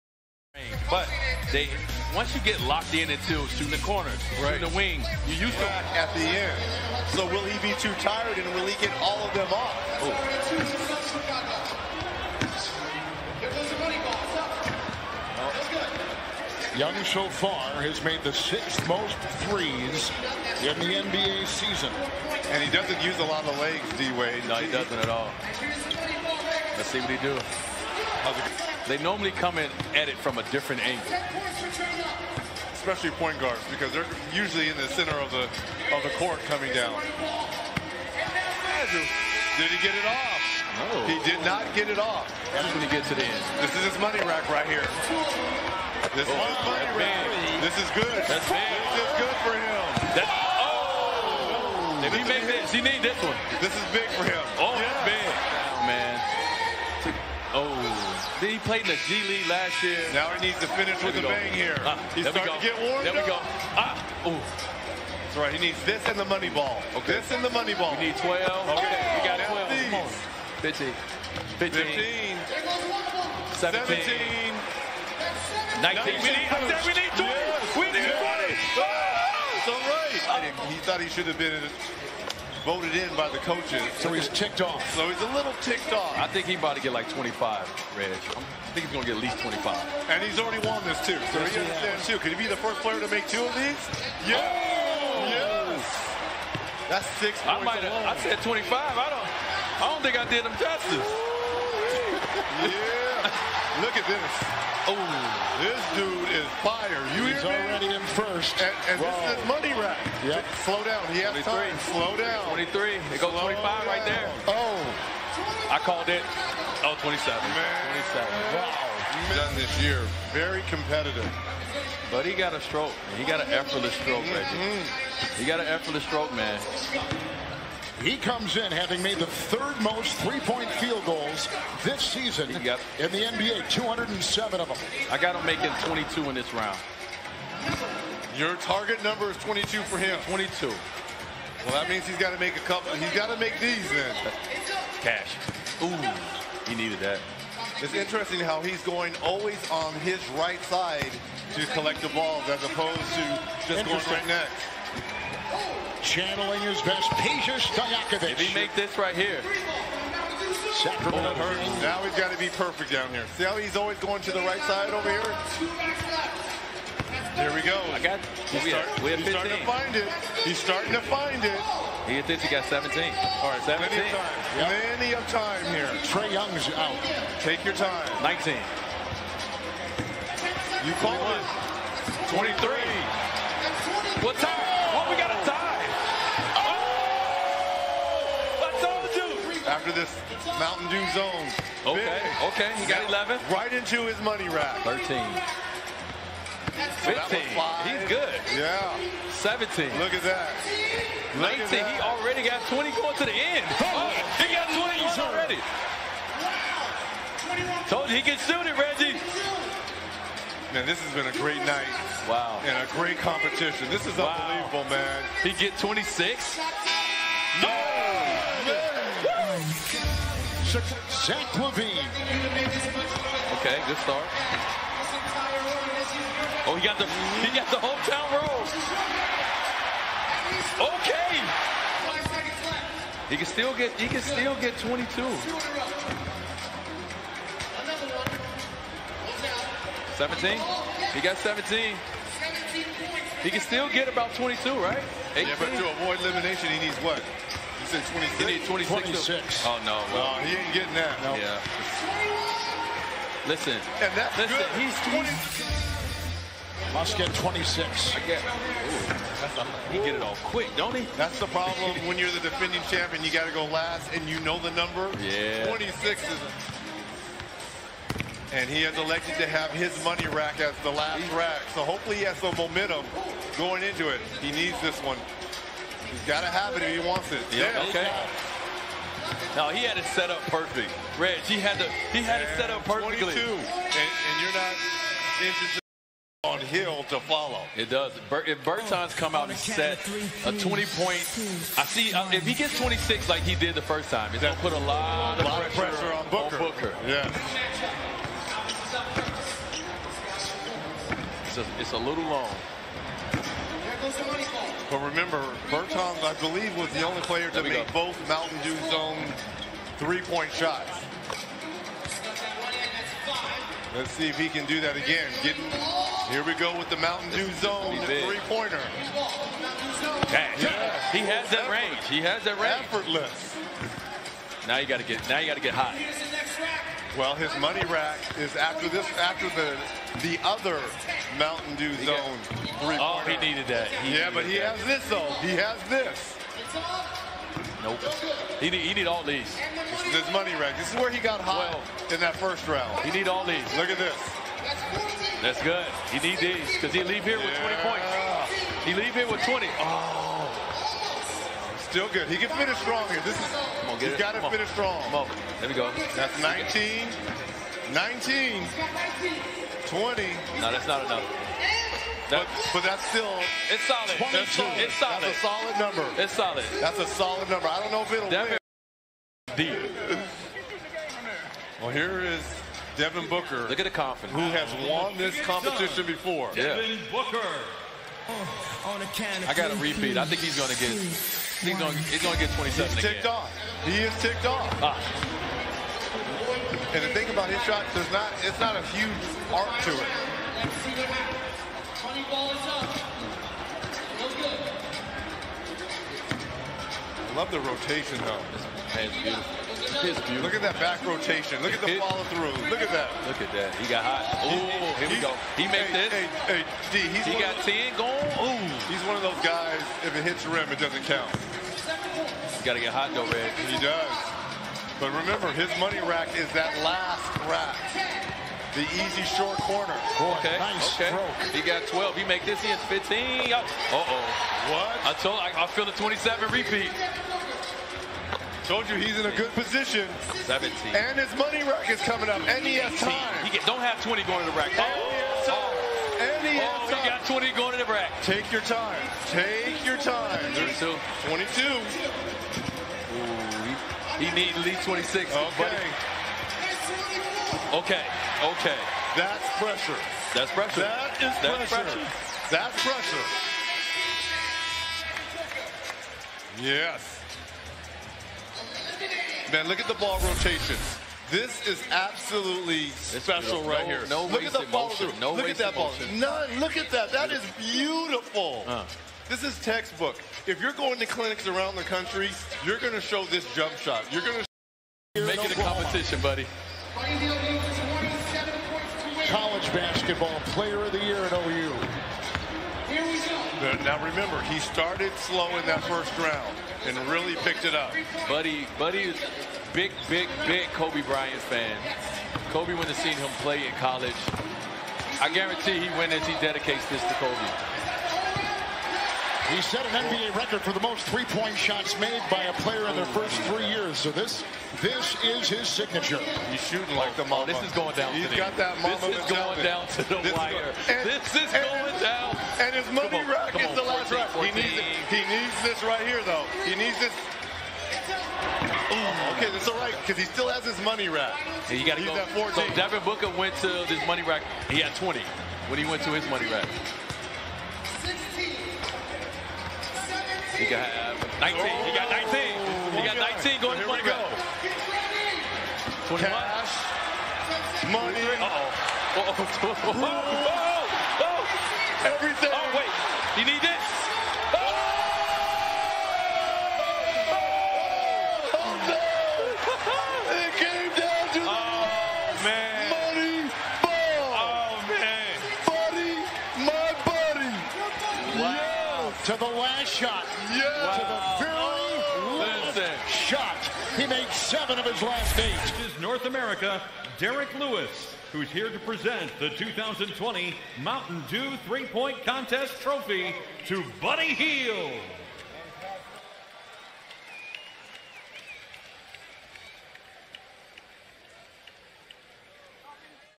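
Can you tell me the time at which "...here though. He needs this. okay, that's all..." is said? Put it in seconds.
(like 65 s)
516 s.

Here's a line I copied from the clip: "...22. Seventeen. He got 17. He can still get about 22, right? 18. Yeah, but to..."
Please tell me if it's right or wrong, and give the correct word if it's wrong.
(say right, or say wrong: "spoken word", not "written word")
right.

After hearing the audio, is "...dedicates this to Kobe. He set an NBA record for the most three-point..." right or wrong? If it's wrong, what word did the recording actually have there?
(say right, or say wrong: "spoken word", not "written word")
right.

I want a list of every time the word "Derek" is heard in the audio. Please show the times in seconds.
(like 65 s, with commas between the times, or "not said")
567 s.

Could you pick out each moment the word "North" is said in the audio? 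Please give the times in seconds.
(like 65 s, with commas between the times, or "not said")
566 s.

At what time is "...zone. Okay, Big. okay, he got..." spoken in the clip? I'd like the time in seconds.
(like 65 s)
191 s.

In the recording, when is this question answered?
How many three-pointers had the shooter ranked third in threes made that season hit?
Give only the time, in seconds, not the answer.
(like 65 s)
133 s.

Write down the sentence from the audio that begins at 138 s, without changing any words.
Your target number is 22 for him.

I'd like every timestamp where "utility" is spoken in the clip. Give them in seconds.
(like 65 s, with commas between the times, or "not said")
not said.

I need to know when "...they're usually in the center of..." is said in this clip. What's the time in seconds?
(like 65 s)
33 s.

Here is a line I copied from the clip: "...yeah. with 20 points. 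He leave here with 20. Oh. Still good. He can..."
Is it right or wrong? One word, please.
right.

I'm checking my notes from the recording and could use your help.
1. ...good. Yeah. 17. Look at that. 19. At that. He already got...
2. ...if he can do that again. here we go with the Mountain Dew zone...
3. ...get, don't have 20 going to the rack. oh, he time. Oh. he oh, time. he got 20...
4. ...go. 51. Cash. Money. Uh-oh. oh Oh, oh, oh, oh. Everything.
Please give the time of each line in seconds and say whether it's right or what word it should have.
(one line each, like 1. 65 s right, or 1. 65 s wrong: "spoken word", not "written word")
1. 198 s right
2. 314 s right
3. 433 s right
4. 534 s wrong: "21", not "51".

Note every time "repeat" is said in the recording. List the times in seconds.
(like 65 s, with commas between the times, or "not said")
379 s, 426 s.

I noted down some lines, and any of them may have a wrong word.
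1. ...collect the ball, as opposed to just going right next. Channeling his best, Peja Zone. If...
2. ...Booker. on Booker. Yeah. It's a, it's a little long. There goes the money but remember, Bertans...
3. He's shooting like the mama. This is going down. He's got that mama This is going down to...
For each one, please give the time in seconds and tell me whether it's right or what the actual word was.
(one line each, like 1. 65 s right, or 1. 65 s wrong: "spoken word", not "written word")
1. 151 s wrong: "Stojakovic", not "Zone"
2. 296 s right
3. 506 s right.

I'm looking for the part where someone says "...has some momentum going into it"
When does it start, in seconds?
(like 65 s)
272 s.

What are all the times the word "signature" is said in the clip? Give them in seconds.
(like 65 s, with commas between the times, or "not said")
505 s.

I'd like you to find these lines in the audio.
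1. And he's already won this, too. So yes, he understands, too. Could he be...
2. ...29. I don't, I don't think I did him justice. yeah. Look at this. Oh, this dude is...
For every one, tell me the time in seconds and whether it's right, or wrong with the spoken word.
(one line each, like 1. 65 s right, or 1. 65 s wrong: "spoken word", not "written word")
1. 90 s right
2. 98 s wrong: "25", not "29".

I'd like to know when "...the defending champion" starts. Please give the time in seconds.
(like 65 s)
262 s.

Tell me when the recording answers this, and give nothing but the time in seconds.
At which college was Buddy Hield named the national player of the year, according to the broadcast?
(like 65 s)
481 s.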